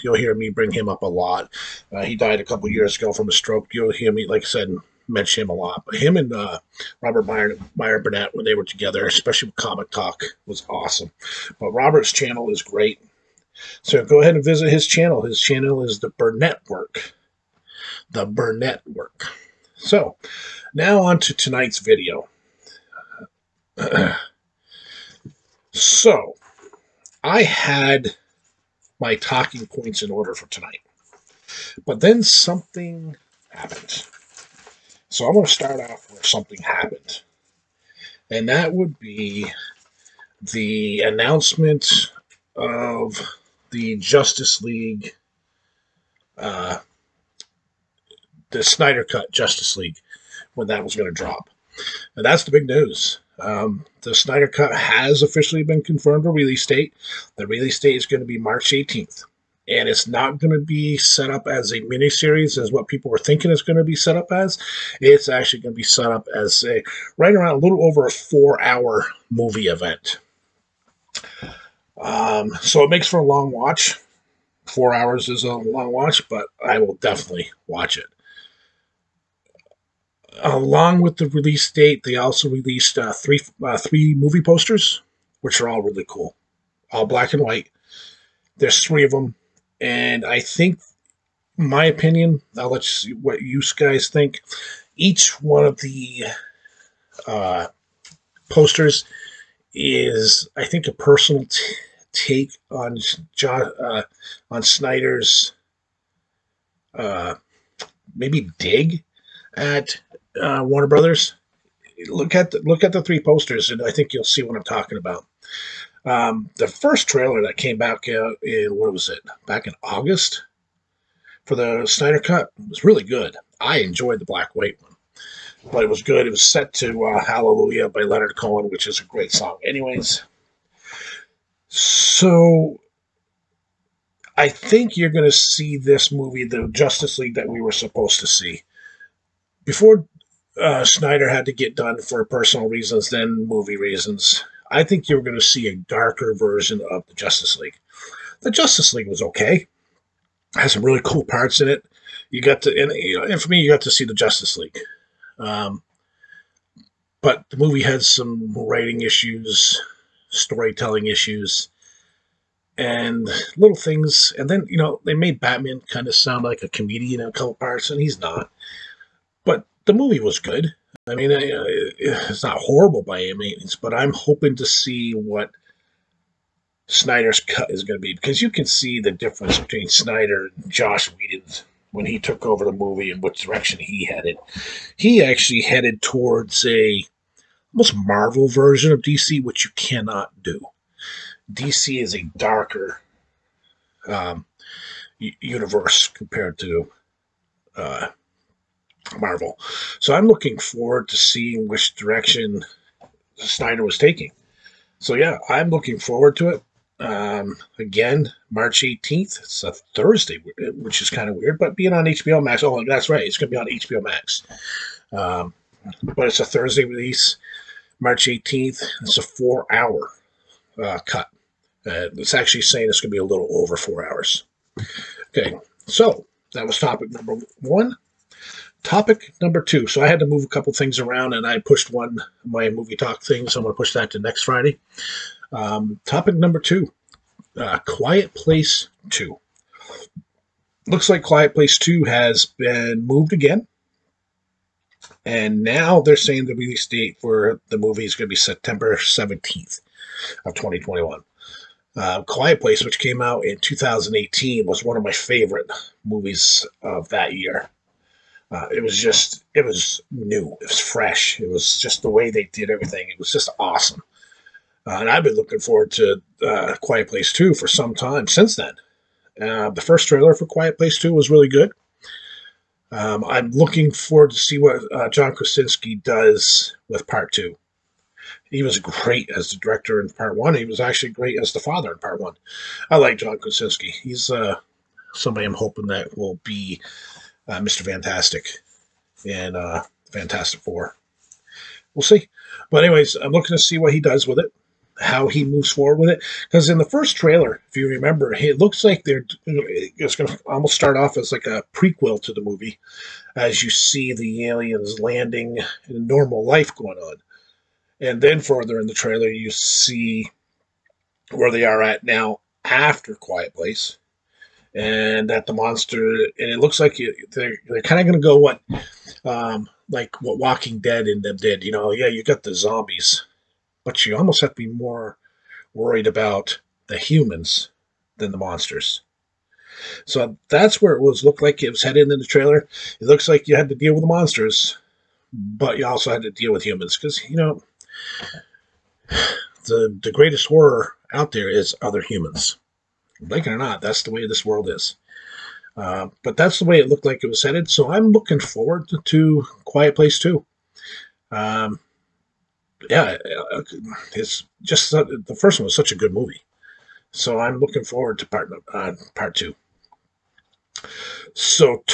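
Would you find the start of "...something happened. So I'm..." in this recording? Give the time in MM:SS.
00:32.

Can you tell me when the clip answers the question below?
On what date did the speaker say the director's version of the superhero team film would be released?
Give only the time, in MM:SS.
00:57.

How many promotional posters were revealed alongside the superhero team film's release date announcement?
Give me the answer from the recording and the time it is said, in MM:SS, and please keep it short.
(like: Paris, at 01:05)
3, at 01:23.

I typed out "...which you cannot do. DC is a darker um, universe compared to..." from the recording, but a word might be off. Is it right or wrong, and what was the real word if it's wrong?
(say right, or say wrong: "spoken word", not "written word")
right.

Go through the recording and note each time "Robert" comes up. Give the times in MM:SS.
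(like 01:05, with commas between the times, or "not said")
00:07, 00:11.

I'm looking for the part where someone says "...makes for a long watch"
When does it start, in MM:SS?
01:12.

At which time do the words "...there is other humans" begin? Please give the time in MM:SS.
05:41.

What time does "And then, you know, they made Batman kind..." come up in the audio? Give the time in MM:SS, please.
02:44.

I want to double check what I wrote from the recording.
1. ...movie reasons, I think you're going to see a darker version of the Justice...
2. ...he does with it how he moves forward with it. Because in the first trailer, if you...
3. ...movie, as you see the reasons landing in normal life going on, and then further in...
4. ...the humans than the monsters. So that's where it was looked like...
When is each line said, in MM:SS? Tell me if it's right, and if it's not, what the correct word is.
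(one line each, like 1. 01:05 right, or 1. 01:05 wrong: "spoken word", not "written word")
1. 02:23 right
2. 04:53 right
3. 05:02 wrong: "aliens", not "reasons"
4. 05:26 right.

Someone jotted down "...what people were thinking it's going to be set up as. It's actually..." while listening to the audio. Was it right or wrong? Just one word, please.
right.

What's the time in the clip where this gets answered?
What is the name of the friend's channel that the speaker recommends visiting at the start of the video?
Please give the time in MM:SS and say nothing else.
00:15.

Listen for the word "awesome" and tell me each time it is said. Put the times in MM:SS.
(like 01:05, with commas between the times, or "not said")
00:10, 04:23.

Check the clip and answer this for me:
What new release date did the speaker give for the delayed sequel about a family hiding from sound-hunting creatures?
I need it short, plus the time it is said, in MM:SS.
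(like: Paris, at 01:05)
September 17th, 2021, at 04:08.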